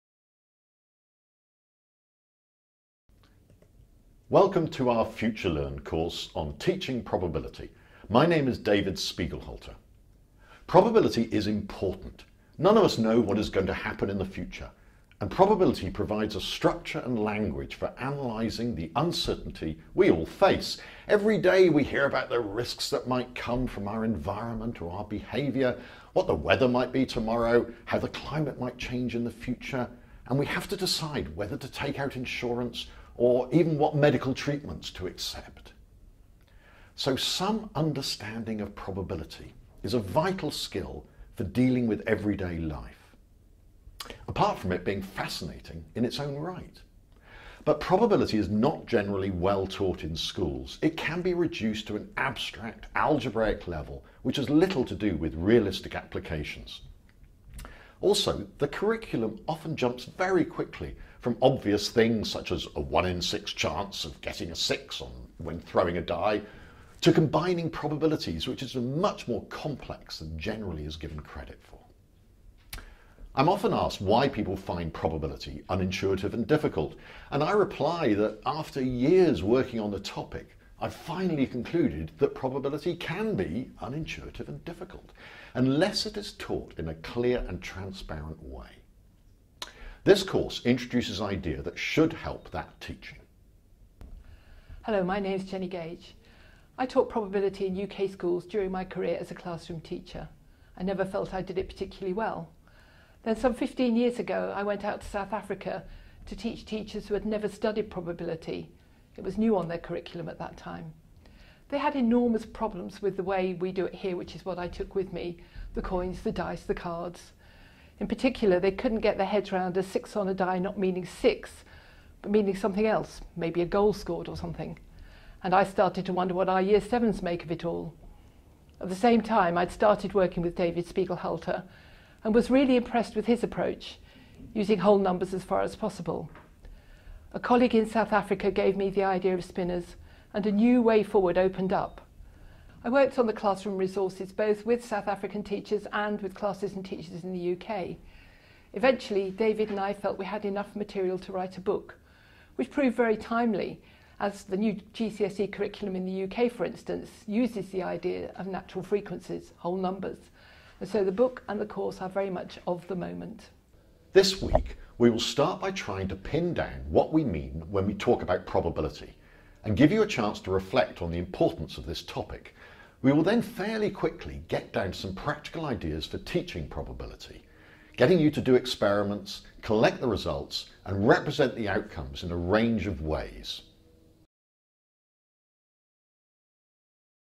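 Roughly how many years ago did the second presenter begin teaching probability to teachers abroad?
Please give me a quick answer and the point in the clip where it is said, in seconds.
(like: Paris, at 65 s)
15, at 103 s.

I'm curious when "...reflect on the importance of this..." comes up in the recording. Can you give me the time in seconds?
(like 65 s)
170 s.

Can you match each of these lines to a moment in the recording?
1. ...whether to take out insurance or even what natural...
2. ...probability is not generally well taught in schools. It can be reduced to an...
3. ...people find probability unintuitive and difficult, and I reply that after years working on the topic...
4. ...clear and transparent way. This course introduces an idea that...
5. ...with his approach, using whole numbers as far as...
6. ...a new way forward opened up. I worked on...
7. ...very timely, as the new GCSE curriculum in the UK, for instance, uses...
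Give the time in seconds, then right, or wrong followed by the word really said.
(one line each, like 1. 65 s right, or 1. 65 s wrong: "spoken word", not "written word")
1. 31 s wrong: "medical", not "natural"
2. 47 s right
3. 74 s right
4. 86 s right
5. 133 s right
6. 140 s right
7. 152 s right.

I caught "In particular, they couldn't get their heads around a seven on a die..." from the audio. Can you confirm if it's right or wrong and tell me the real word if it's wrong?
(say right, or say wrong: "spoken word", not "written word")
wrong: "six", not "seven".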